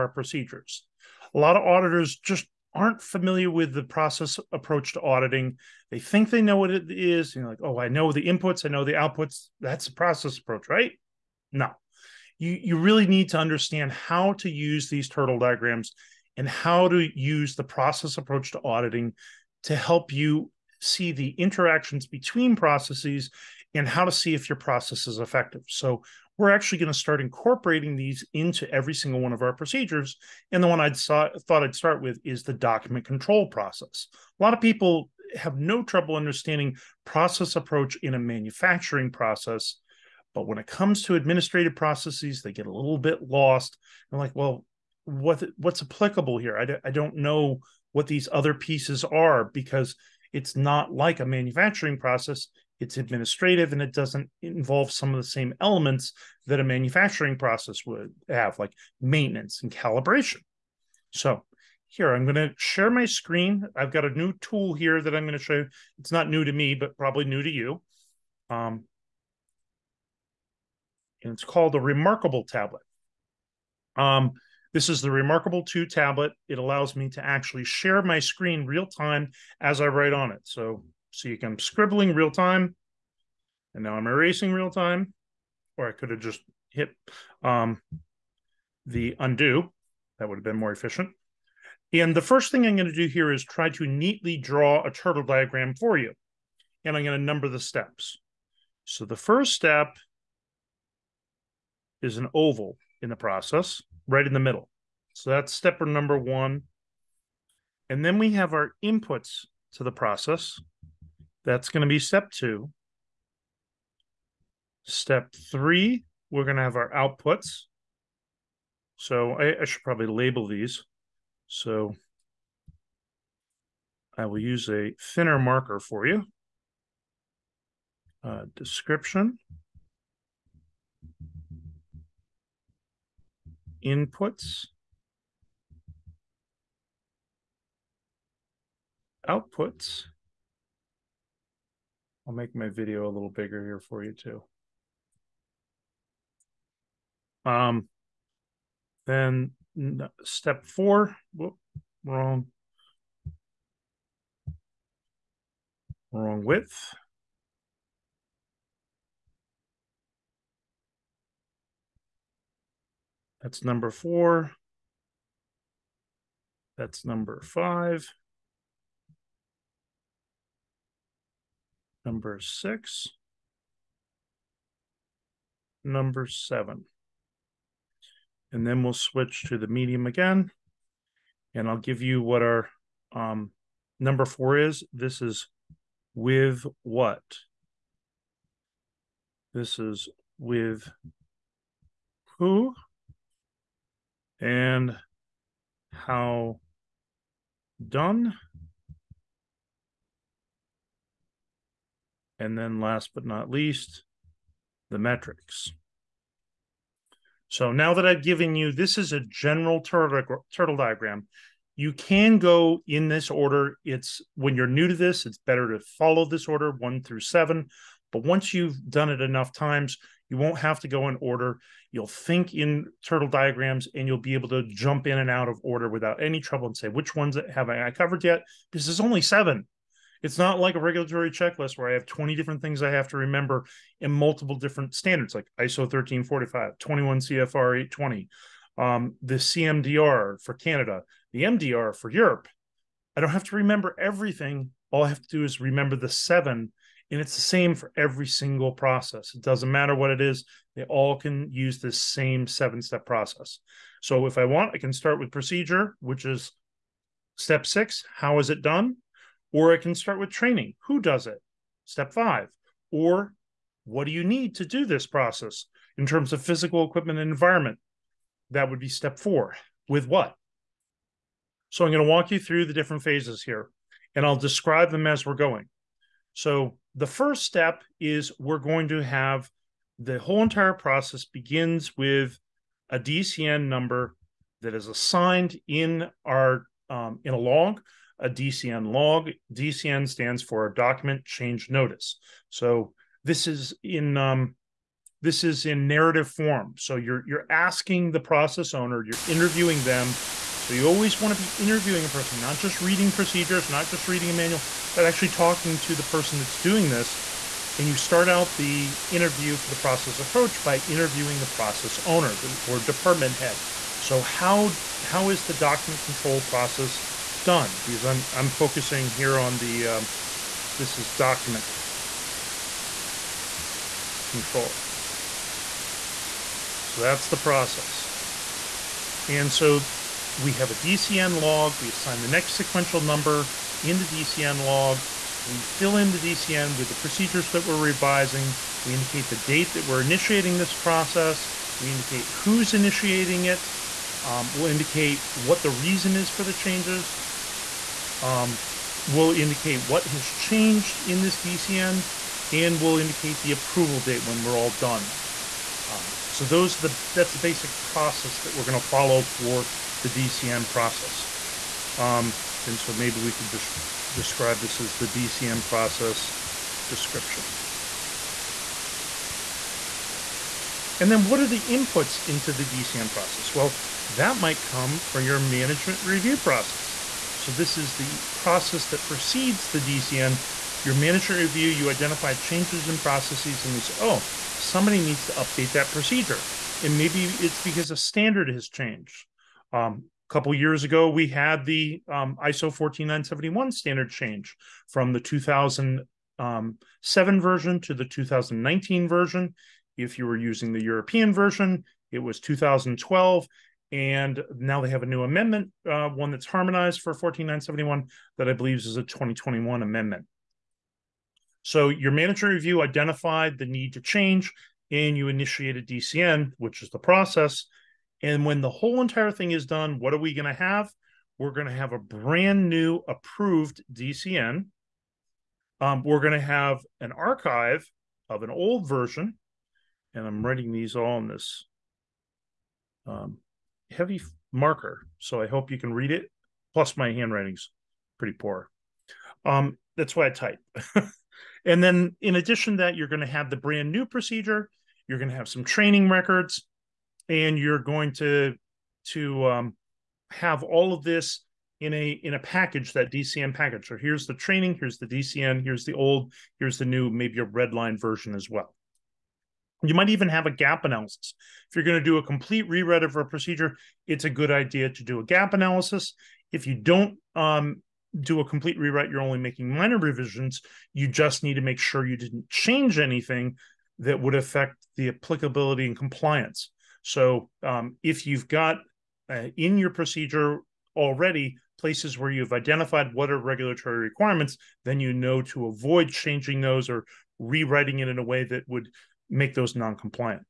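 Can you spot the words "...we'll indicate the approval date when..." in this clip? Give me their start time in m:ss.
5:52.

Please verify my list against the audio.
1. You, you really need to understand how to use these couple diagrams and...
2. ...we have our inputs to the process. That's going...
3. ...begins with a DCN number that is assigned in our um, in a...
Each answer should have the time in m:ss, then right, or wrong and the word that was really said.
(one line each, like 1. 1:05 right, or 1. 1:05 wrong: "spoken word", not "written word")
1. 0:12 wrong: "turtle", not "couple"
2. 1:48 right
3. 4:41 right.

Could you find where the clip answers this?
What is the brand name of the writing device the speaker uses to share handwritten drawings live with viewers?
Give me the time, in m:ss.
1:15.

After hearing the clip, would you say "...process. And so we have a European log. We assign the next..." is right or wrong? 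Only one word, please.
wrong.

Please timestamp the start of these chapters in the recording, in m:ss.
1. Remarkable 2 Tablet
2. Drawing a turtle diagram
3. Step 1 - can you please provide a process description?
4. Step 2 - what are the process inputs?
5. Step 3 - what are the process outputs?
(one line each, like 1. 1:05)
1. 1:15
2. 1:38
3. 4:39
4. 6:10
5. 6:57.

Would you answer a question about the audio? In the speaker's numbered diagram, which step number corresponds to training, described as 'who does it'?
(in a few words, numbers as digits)
5.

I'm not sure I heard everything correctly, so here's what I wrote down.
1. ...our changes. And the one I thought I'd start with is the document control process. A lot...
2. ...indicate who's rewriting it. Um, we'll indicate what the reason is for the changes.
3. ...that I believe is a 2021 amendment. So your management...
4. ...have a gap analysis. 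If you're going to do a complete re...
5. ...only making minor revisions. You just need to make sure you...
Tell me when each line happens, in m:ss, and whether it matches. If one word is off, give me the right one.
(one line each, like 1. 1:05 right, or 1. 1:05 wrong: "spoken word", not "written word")
1. 0:29 wrong: "procedures", not "changes"
2. 5:41 wrong: "initiating", not "rewriting"
3. 6:48 right
4. 7:40 right
5. 7:49 right.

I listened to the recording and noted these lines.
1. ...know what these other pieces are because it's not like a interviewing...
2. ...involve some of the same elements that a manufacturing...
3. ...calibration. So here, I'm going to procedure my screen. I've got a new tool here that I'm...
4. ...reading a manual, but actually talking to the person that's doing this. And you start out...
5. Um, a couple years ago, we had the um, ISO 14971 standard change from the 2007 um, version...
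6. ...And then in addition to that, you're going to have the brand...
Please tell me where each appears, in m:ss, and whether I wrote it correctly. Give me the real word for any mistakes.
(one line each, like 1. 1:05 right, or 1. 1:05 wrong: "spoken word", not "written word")
1. 0:47 wrong: "manufacturing", not "interviewing"
2. 0:54 right
3. 0:59 wrong: "share", not "procedure"
4. 5:04 right
5. 6:29 right
6. 7:21 right.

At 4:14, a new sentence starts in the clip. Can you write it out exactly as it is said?
So if I want, I can start with procedure, which is step six how is it done?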